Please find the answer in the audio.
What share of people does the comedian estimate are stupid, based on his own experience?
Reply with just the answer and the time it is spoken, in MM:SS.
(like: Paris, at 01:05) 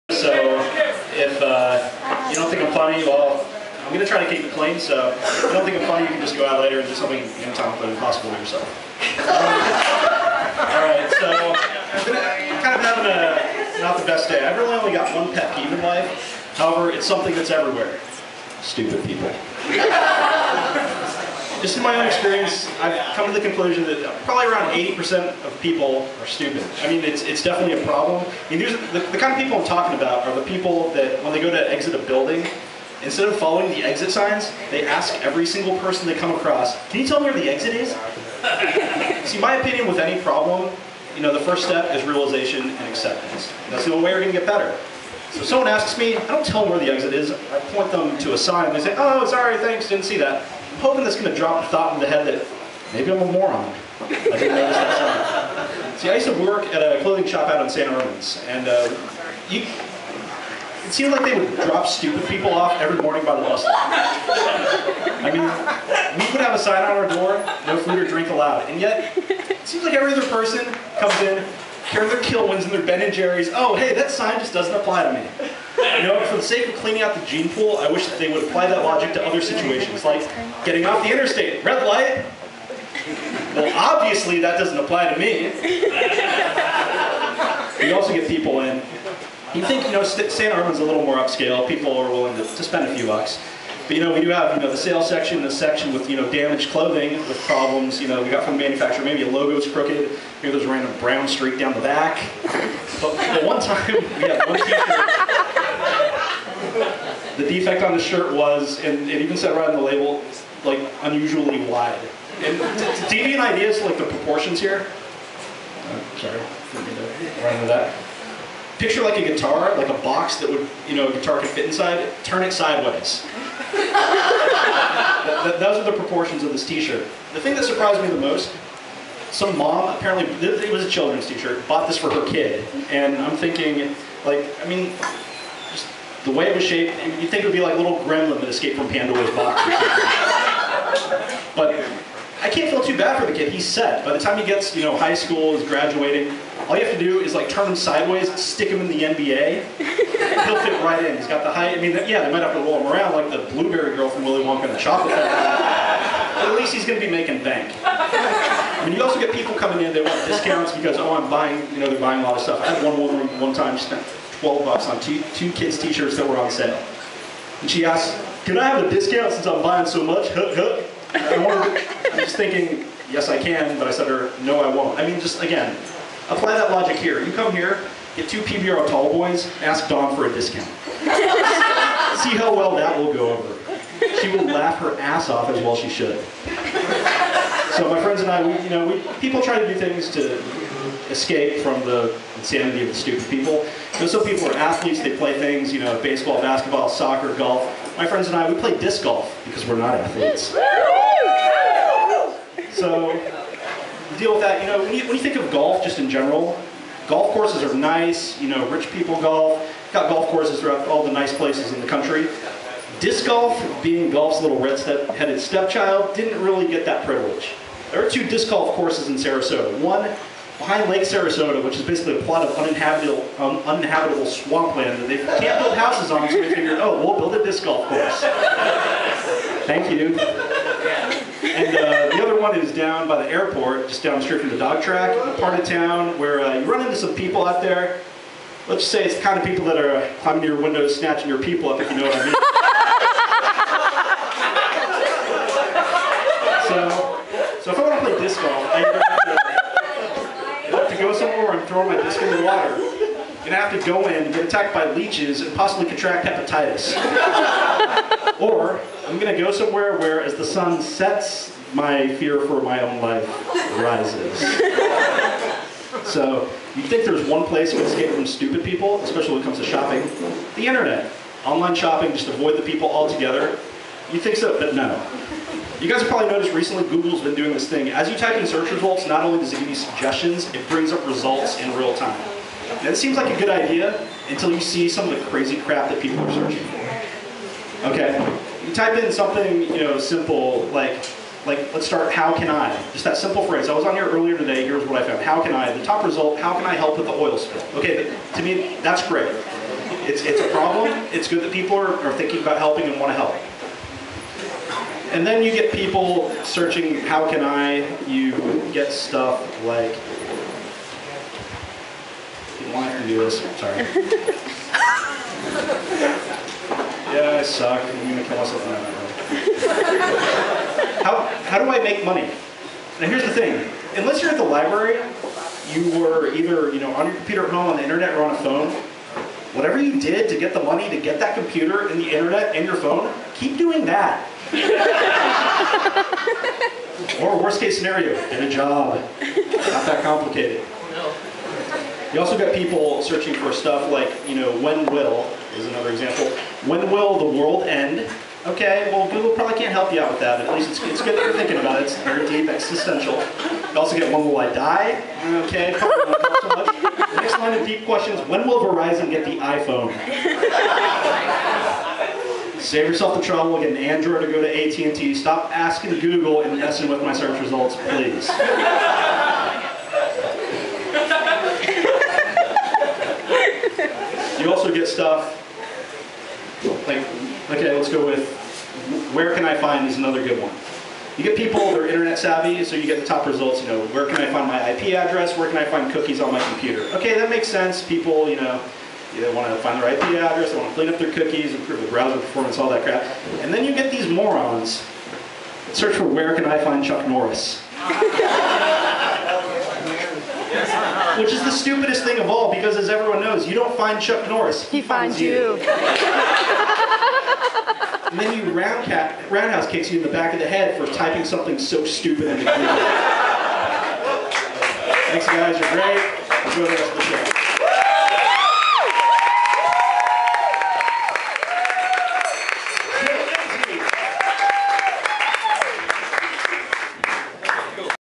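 80%, at 00:24.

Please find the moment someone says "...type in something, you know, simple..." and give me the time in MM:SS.
04:48.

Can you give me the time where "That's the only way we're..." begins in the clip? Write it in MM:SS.
00:43.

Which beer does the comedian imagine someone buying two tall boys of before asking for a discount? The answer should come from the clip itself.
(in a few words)
PBR.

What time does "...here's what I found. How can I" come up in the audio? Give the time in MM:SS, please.
04:54.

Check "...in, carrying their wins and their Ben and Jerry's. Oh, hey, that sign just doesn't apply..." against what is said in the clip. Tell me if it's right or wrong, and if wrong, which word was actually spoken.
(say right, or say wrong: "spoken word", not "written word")
right.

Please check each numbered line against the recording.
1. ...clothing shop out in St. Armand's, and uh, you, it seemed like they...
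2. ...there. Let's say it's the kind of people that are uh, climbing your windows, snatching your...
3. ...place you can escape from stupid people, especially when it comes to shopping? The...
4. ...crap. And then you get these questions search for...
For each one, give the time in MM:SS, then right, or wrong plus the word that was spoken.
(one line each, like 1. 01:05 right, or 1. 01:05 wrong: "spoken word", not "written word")
1. 00:57 right
2. 03:57 right
3. 04:27 right
4. 06:32 wrong: "morons", not "questions".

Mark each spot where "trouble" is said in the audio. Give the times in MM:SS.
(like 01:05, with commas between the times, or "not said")
06:03.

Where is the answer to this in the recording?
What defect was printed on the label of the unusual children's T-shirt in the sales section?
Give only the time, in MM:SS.
01:51.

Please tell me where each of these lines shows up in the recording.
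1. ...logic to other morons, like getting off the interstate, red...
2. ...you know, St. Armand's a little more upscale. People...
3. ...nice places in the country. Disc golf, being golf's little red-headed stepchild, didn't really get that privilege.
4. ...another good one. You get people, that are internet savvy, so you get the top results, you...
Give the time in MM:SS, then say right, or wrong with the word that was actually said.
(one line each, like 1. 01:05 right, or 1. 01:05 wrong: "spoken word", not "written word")
1. 01:18 wrong: "situations", not "morons"
2. 01:29 right
3. 03:31 right
4. 06:19 right.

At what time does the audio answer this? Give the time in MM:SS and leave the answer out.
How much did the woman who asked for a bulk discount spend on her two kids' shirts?
02:44.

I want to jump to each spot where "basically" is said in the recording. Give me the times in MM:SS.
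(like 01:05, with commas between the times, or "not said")
03:41.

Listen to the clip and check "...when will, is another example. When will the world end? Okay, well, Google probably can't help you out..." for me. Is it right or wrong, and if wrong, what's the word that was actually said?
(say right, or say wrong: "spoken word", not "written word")
right.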